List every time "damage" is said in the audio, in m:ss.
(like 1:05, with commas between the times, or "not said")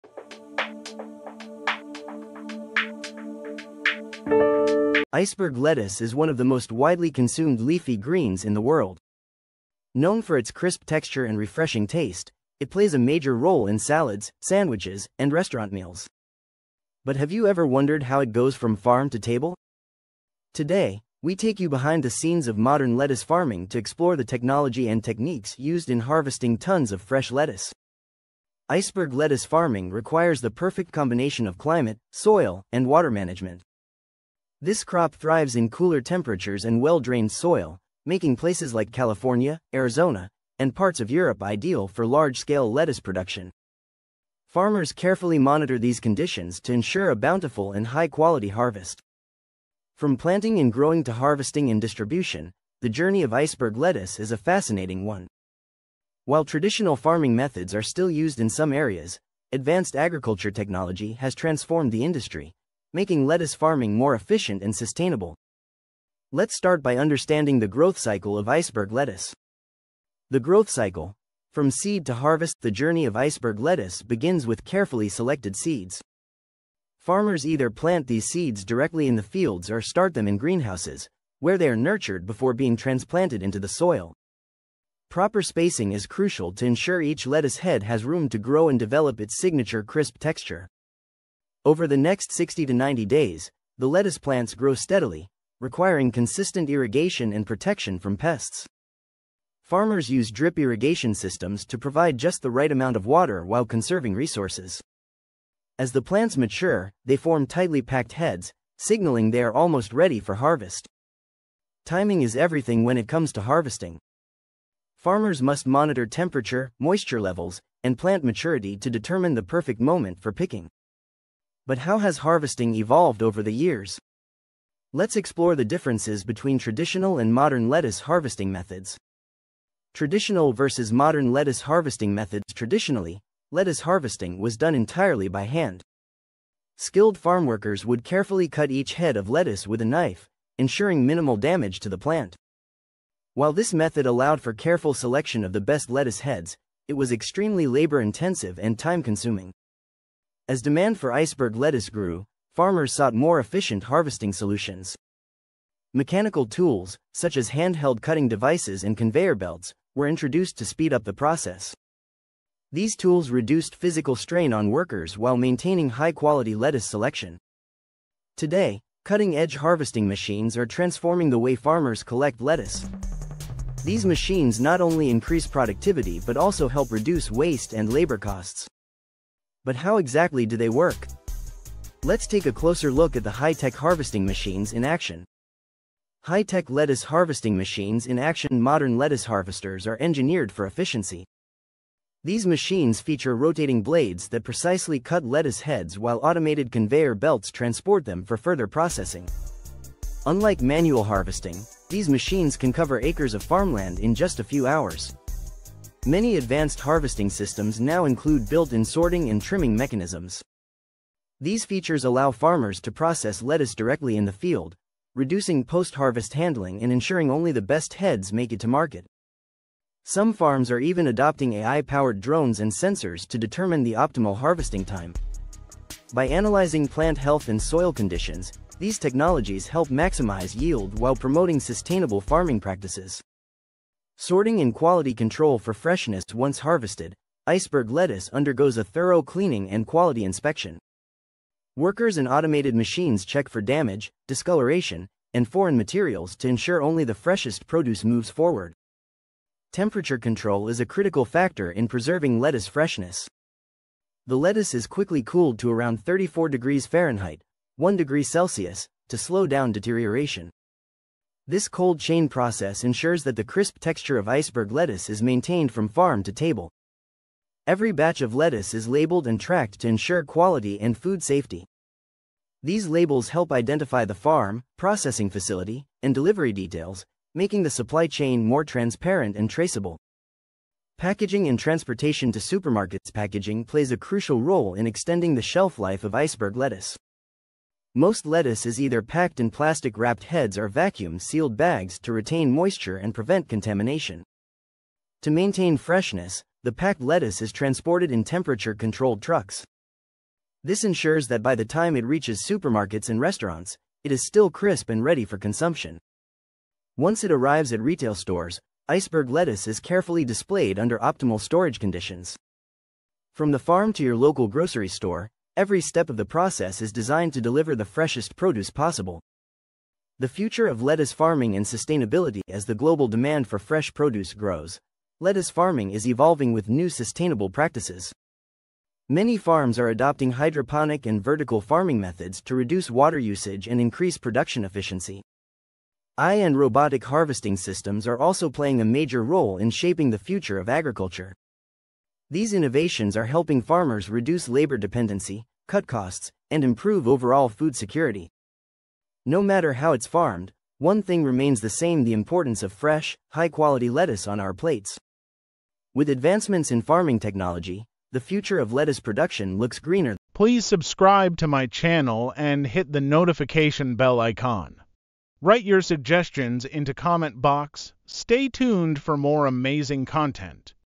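2:21, 4:03.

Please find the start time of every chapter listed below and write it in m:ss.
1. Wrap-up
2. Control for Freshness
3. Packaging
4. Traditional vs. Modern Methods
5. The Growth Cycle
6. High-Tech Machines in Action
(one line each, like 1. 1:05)
1. 5:20
2. 3:54
3. 4:41
4. 2:05
5. 1:10
6. 3:06.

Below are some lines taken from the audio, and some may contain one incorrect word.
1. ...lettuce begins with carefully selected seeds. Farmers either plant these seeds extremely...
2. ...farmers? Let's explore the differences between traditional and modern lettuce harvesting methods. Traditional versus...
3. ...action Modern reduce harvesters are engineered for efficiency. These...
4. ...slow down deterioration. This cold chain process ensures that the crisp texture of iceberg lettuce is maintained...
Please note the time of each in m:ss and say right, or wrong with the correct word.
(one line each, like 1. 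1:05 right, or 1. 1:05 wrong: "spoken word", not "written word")
1. 1:13 wrong: "directly", not "extremely"
2. 2:03 wrong: "years", not "farmers"
3. 3:08 wrong: "lettuce", not "reduce"
4. 4:19 right.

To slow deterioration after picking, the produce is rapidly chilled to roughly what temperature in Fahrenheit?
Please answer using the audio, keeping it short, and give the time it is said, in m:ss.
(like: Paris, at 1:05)
34 degrees Fahrenheit, at 4:16.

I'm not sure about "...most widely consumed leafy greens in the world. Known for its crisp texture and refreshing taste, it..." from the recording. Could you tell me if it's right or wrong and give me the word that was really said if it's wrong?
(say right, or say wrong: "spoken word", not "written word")
right.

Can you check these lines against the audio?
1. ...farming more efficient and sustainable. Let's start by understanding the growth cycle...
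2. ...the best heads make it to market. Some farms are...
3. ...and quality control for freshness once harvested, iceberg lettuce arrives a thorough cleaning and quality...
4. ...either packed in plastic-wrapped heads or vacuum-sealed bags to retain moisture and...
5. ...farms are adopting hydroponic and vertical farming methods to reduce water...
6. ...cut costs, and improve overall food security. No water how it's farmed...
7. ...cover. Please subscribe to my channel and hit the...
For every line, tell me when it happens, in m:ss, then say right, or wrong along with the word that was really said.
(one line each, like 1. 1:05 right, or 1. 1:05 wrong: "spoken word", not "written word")
1. 1:03 right
2. 3:37 right
3. 3:54 wrong: "undergoes", not "arrives"
4. 4:48 right
5. 5:29 right
6. 5:45 wrong: "matter", not "water"
7. 5:59 wrong: "greener", not "cover".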